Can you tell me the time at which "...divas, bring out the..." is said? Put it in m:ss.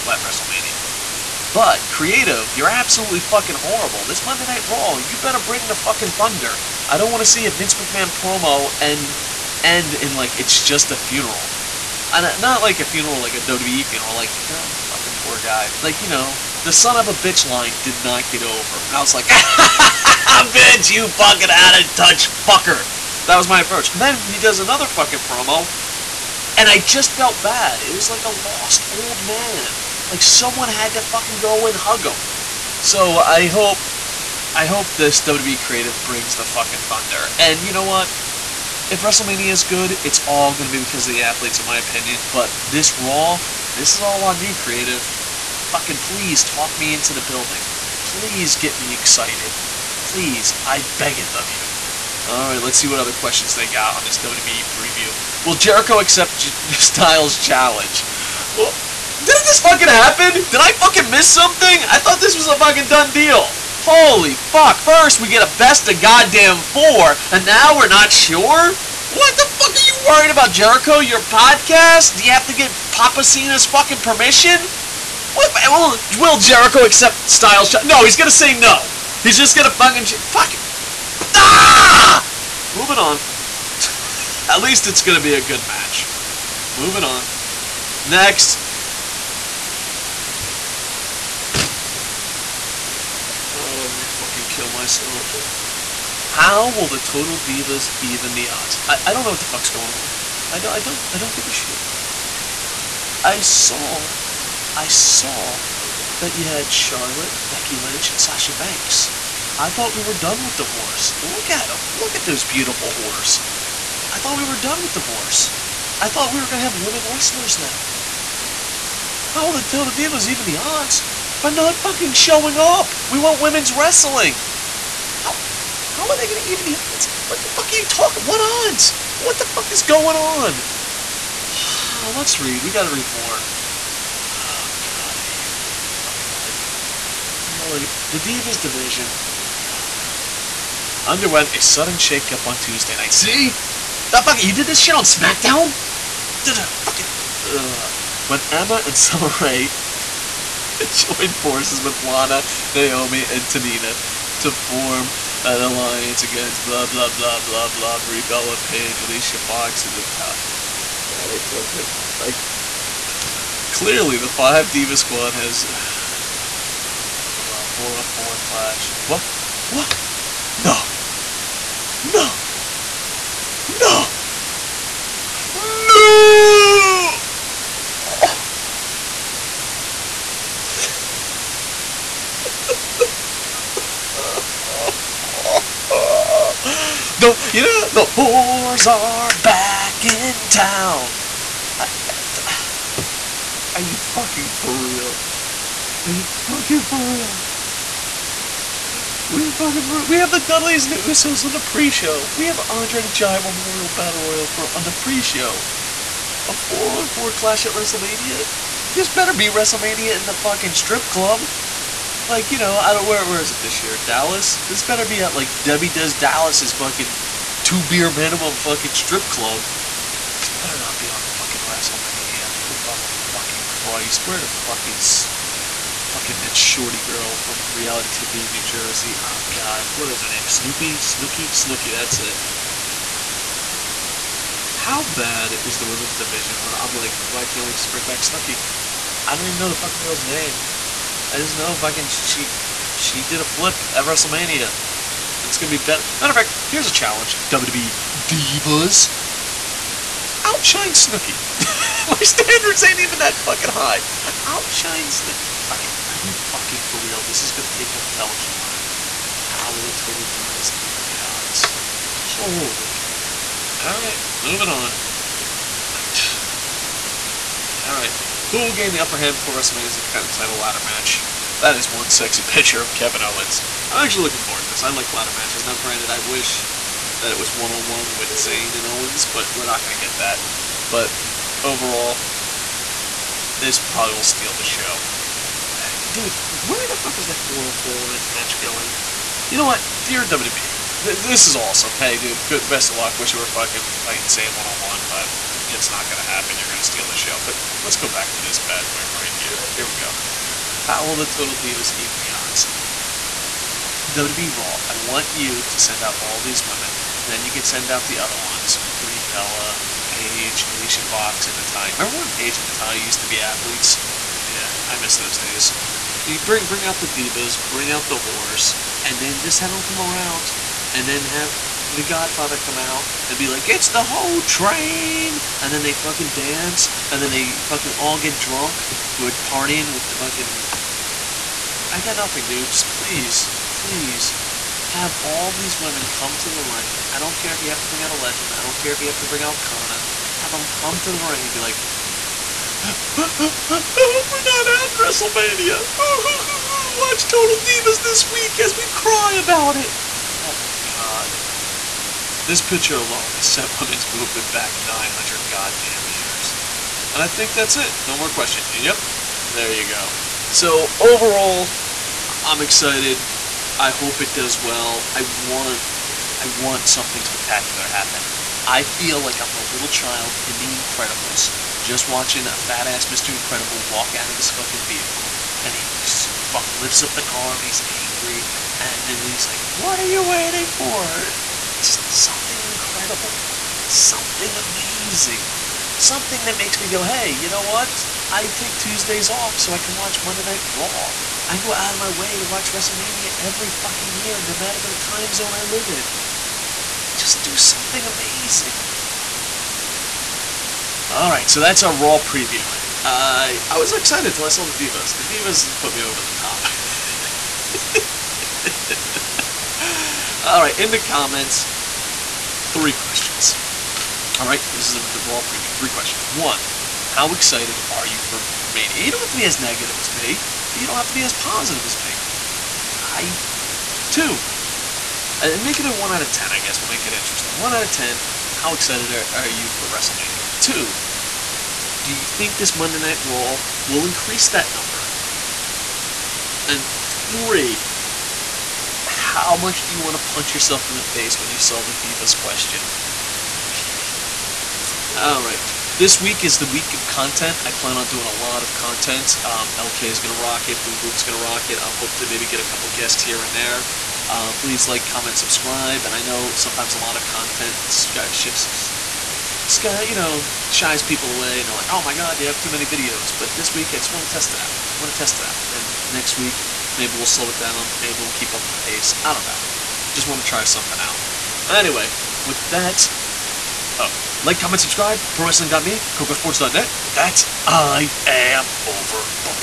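5:17.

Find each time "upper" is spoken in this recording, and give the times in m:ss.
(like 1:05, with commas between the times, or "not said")
4:28.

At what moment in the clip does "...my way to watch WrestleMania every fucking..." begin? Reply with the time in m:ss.
6:31.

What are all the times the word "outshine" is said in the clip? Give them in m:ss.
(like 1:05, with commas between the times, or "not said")
4:10, 4:14.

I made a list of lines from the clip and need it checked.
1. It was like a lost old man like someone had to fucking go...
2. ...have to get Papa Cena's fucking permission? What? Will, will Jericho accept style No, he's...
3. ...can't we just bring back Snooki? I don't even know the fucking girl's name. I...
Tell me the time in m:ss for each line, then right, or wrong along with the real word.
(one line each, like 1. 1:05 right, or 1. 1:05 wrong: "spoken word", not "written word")
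1. 0:27 right
2. 1:12 right
3. 3:57 right.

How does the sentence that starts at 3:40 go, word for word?
This better not be on fucking WrestleMania.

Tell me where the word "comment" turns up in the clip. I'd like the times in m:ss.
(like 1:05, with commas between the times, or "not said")
6:50, 7:35, 7:54.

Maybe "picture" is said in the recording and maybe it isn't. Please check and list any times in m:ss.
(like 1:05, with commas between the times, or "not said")
4:32, 5:52.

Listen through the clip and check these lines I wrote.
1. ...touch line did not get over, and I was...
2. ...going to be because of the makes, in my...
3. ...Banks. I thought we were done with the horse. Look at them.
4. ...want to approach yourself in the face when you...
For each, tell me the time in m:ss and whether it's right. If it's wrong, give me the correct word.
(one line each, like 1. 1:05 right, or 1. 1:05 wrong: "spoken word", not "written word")
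1. 0:17 wrong: "bitch", not "touch"
2. 0:40 wrong: "athletes", not "makes"
3. 1:48 right
4. 7:19 wrong: "punch", not "approach".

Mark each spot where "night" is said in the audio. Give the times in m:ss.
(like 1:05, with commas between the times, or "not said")
0:04, 2:22, 6:30, 7:12.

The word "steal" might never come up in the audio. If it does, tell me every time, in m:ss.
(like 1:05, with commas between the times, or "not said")
4:44, 4:56.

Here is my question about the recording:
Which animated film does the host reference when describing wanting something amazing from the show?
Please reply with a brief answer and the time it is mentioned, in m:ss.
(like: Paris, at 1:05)
The Incredibles, at 6:10.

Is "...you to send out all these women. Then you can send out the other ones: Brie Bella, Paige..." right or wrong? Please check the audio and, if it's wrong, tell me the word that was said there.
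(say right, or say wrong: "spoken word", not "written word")
right.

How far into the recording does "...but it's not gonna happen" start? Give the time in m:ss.
4:55.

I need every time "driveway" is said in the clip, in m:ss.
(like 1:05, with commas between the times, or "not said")
not said.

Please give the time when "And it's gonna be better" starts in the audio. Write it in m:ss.
4:04.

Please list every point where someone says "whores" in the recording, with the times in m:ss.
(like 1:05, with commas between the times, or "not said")
3:08.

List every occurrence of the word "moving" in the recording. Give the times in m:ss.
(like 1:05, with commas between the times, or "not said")
1:22, 1:26, 4:24.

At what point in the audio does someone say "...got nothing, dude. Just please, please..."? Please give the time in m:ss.
5:32.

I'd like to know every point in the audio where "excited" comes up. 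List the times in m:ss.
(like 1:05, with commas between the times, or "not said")
0:48, 6:02, 6:43, 6:57, 7:08.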